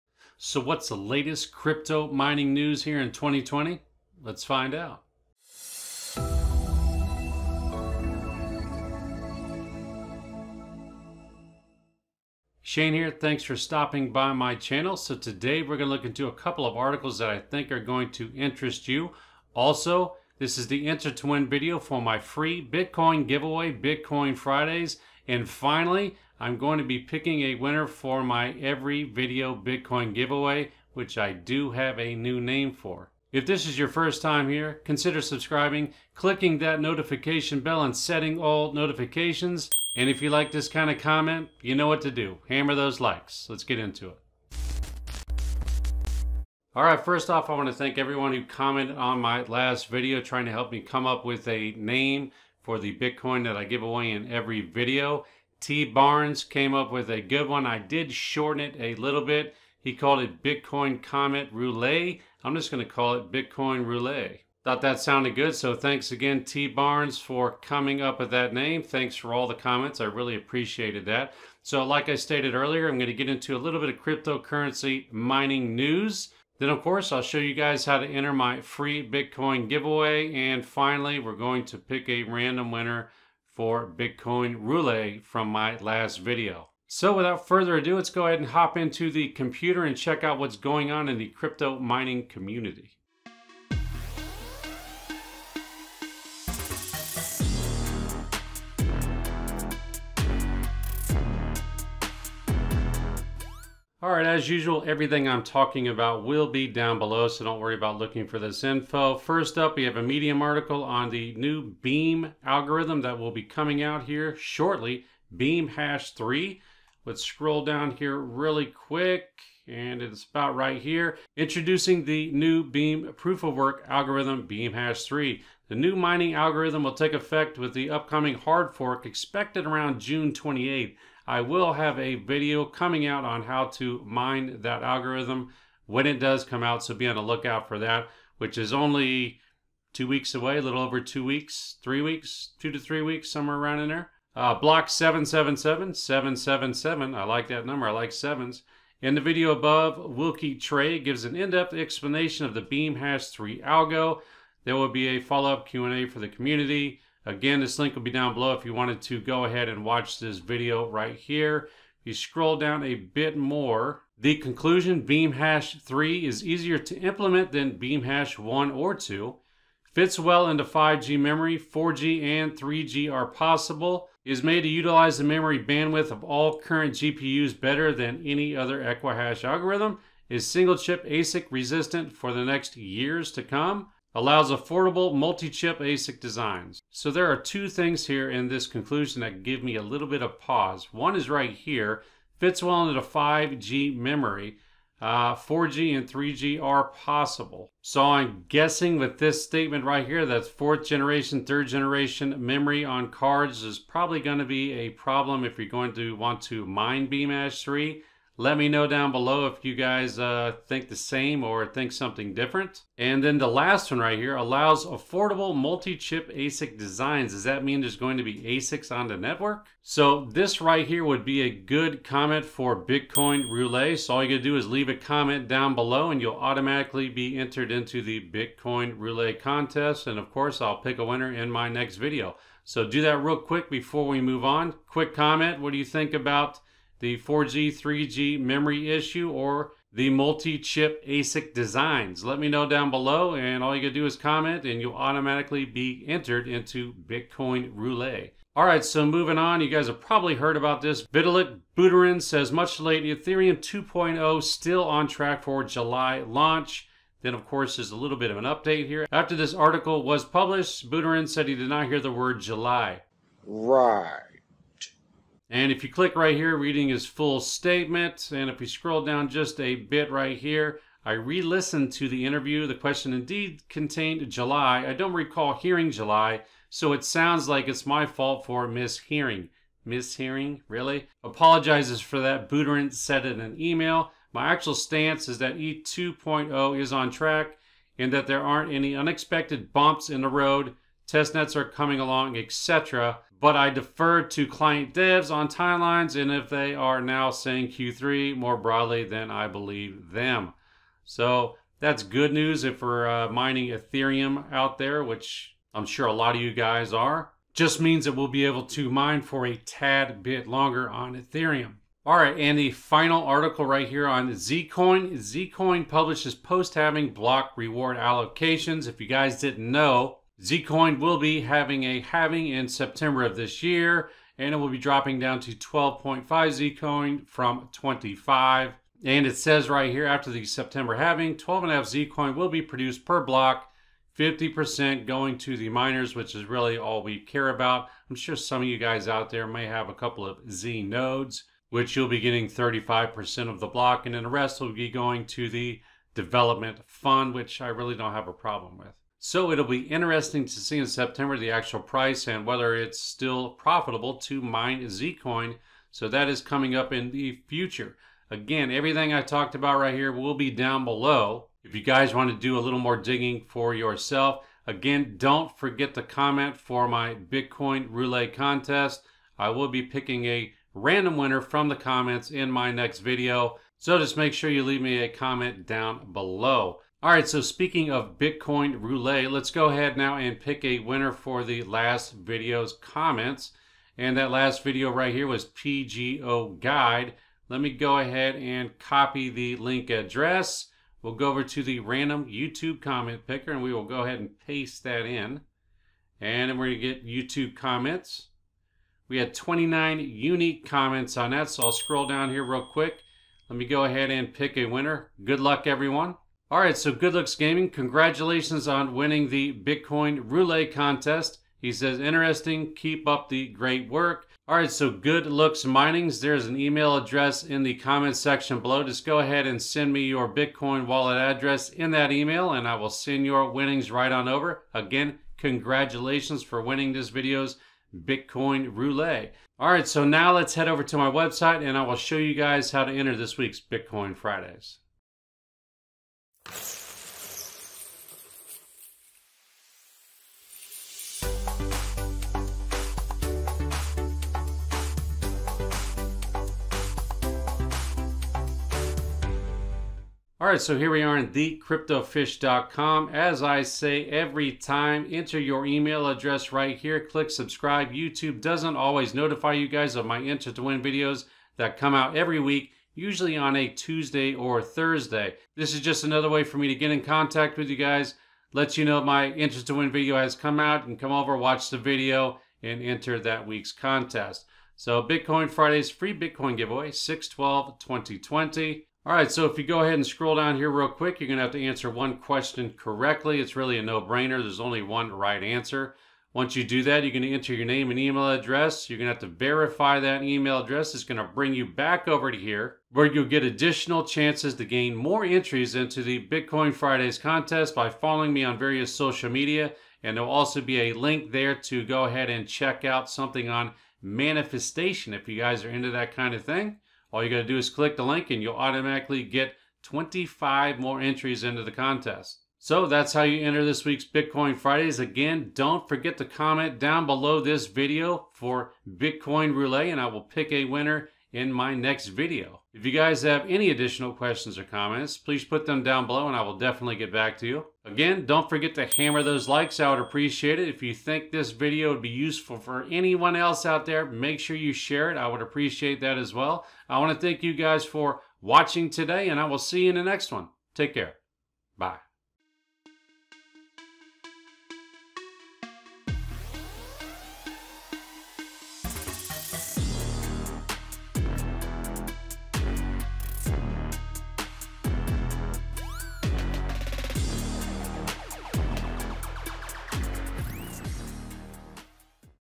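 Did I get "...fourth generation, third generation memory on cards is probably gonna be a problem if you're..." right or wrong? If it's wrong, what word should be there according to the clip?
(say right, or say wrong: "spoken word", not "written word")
right.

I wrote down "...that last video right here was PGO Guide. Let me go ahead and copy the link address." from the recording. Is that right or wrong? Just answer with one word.
right.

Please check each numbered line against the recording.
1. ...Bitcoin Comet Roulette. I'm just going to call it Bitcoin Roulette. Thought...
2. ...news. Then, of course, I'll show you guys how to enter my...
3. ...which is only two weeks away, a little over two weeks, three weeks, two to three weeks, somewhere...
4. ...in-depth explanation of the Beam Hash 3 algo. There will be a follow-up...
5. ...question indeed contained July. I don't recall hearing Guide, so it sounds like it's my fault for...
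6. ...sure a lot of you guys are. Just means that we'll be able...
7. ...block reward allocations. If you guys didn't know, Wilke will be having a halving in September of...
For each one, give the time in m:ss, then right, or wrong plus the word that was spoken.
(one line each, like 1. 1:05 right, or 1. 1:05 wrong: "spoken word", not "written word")
1. 1:00 right
2. 1:15 right
3. 2:18 right
4. 2:31 right
5. 4:32 wrong: "July", not "Guide"
6. 5:05 right
7. 5:17 wrong: "Zcoin", not "Wilke".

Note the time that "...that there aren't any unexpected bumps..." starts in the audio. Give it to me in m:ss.
4:48.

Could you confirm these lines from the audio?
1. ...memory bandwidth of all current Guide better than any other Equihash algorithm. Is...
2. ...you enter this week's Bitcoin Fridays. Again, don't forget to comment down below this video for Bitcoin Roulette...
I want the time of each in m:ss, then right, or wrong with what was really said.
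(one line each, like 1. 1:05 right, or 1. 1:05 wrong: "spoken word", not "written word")
1. 2:55 wrong: "GPUs", not "Guide"
2. 8:33 right.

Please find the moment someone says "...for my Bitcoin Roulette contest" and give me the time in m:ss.
6:06.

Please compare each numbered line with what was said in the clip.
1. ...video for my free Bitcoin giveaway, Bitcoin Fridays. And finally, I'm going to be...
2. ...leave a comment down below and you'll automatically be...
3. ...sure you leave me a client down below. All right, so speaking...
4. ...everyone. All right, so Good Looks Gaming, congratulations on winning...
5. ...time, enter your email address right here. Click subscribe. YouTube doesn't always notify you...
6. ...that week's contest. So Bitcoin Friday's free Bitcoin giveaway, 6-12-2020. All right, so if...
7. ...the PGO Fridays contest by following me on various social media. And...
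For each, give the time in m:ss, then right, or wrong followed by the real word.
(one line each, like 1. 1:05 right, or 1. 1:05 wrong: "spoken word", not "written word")
1. 0:21 right
2. 3:44 right
3. 6:14 wrong: "comment", not "client"
4. 6:45 right
5. 7:34 right
6. 7:53 right
7. 8:16 wrong: "Bitcoin", not "PGO".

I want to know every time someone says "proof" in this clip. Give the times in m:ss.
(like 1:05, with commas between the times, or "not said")
2:03.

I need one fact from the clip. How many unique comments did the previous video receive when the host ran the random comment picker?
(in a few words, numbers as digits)
29.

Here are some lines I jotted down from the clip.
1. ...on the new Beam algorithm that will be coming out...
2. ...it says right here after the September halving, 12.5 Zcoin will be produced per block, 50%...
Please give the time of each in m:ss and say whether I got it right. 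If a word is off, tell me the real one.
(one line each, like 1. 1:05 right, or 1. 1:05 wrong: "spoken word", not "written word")
1. 1:50 right
2. 5:29 right.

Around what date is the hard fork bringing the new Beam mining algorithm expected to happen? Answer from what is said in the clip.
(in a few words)
June 28th.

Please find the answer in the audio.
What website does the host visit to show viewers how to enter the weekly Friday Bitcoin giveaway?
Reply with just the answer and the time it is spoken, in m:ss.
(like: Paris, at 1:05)
thecryptofish.com, at 7:31.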